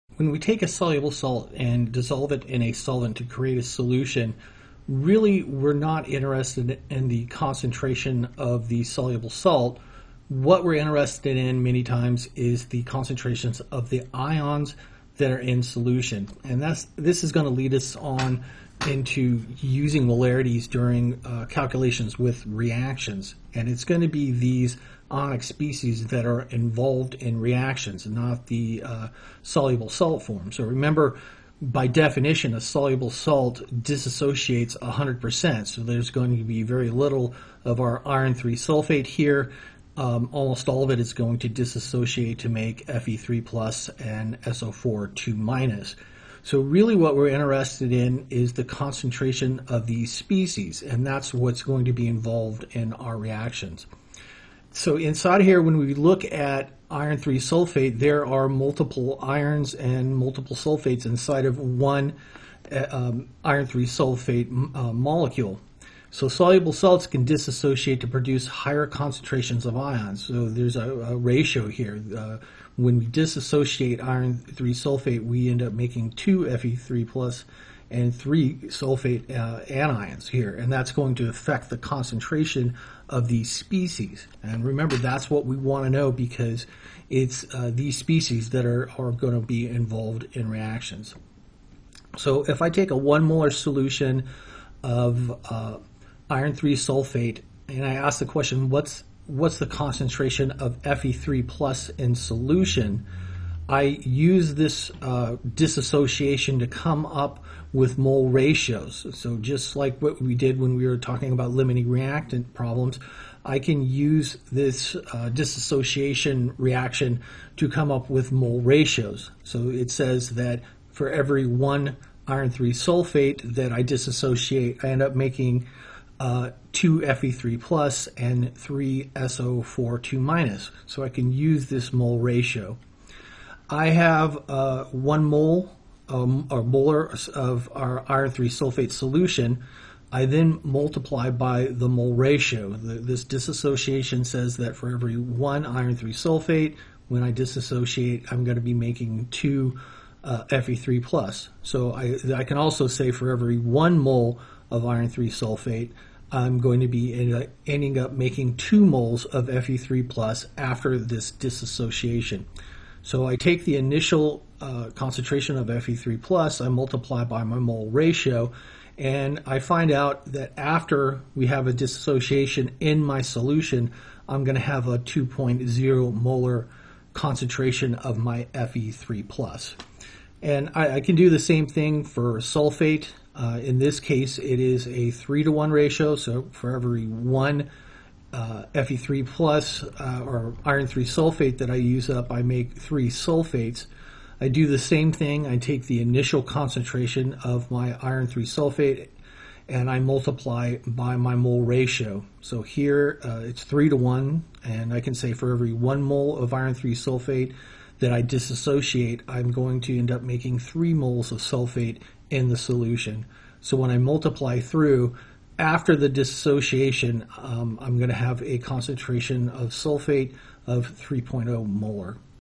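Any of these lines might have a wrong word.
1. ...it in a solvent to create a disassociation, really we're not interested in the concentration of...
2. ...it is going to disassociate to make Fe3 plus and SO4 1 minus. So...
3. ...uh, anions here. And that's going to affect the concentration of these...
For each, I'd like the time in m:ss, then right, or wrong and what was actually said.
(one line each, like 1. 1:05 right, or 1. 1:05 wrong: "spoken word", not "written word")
1. 0:02 wrong: "solution", not "disassociation"
2. 0:40 wrong: "2", not "1"
3. 1:19 right.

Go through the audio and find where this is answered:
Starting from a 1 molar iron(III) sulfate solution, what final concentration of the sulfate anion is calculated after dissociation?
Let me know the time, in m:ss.
3:40.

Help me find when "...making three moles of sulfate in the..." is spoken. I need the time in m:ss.
3:30.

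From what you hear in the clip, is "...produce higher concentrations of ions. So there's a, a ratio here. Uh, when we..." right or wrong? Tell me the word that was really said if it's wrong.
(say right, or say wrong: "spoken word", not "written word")
right.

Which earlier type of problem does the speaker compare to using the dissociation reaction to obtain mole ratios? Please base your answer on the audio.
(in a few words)
limiting reactant problems.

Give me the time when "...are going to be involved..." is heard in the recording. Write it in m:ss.
1:28.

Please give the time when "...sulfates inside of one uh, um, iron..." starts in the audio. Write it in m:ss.
1:00.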